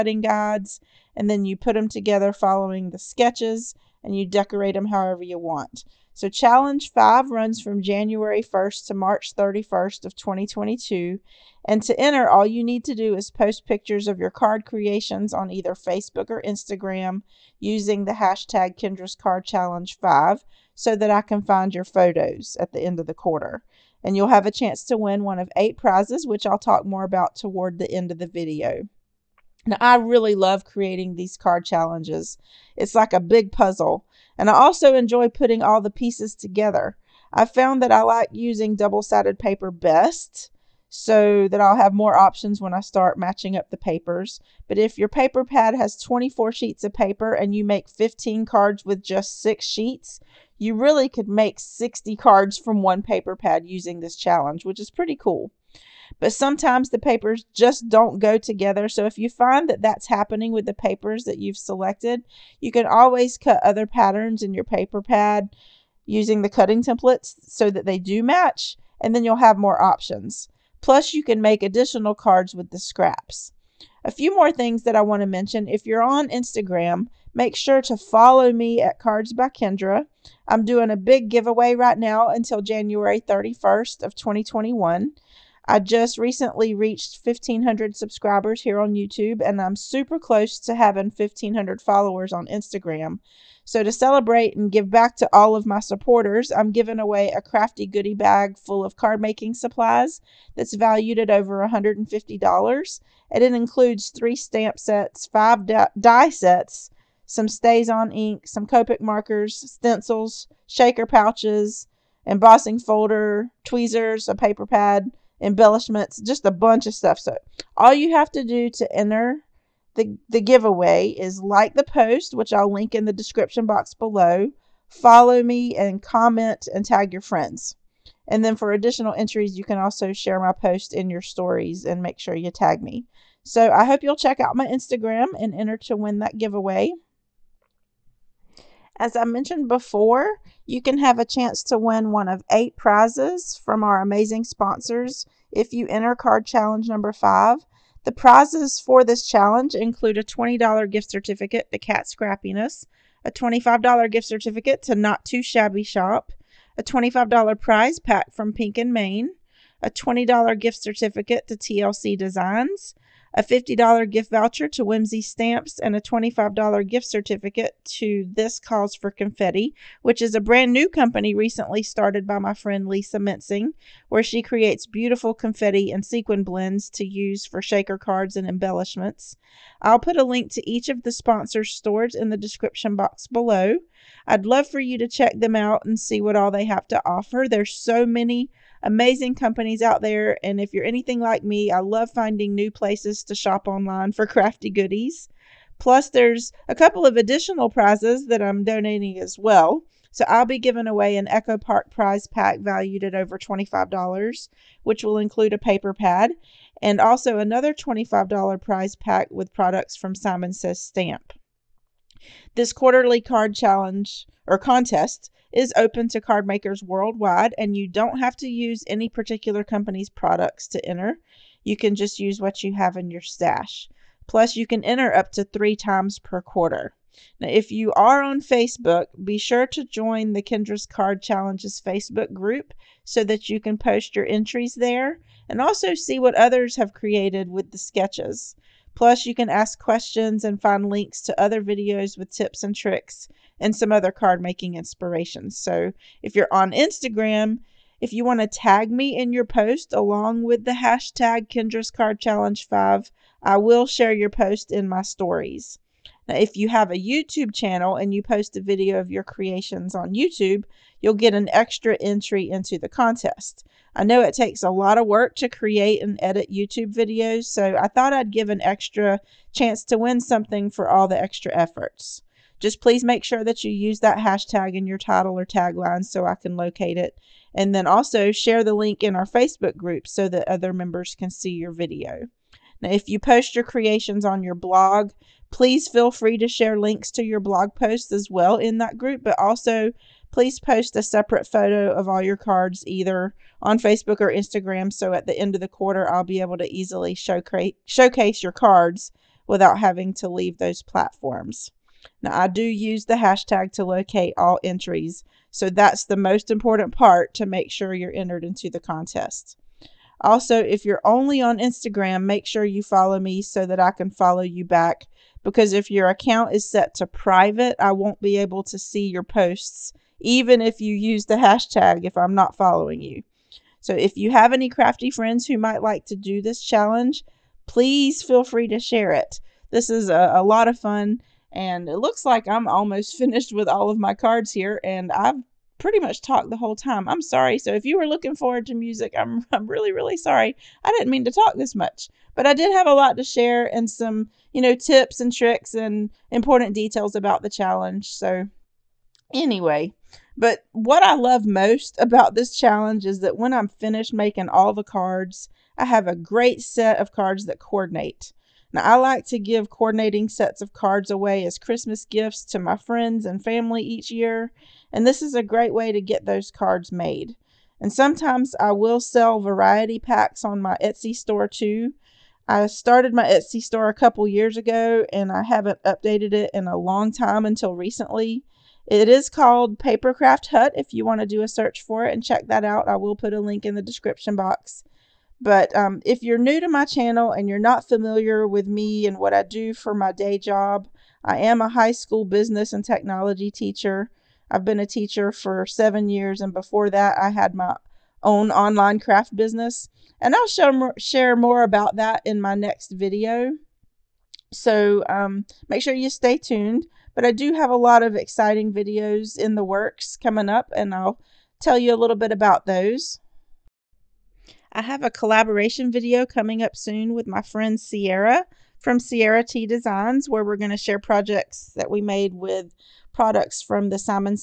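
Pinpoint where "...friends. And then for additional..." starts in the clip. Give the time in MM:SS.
02:07.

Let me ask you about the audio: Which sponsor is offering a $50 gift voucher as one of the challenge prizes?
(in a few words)
Whimsy Stamps.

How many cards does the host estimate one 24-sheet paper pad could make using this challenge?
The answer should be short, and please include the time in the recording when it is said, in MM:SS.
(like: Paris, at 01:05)
60, at 00:51.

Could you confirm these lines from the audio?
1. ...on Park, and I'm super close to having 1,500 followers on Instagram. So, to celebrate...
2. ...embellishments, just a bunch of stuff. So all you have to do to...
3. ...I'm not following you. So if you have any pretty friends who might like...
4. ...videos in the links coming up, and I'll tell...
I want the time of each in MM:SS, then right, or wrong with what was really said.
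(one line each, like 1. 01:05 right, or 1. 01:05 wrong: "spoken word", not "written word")
1. 01:28 wrong: "YouTube", not "Park"
2. 01:55 right
3. 05:22 wrong: "crafty", not "pretty"
4. 06:48 wrong: "works", not "links".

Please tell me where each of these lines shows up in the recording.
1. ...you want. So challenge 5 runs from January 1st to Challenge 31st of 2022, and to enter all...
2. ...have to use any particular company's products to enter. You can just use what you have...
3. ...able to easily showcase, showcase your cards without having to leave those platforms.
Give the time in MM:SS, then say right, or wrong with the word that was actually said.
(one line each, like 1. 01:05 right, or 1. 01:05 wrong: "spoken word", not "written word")
1. 00:05 wrong: "March", not "Challenge"
2. 03:38 right
3. 04:56 right.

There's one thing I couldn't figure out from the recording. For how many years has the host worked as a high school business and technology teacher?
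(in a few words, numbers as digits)
7.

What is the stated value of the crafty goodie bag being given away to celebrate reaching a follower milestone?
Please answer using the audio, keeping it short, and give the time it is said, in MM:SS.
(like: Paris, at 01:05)
Over $150, at 01:41.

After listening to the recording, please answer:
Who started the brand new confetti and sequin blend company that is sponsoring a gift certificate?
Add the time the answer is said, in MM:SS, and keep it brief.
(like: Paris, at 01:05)
Lisa Mensing, at 02:52.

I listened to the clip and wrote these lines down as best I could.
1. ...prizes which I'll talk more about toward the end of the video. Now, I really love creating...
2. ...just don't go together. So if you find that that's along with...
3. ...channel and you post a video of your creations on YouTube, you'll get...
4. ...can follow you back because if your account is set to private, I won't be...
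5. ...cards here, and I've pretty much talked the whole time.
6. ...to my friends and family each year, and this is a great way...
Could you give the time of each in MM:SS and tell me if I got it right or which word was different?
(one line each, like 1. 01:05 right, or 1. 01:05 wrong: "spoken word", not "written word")
1. 00:25 right
2. 00:57 wrong: "happening", not "along"
3. 04:17 right
4. 05:13 right
5. 05:34 right
6. 06:02 right.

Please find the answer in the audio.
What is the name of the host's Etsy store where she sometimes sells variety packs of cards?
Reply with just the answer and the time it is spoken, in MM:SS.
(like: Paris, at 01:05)
Papercraft Hut, at 06:19.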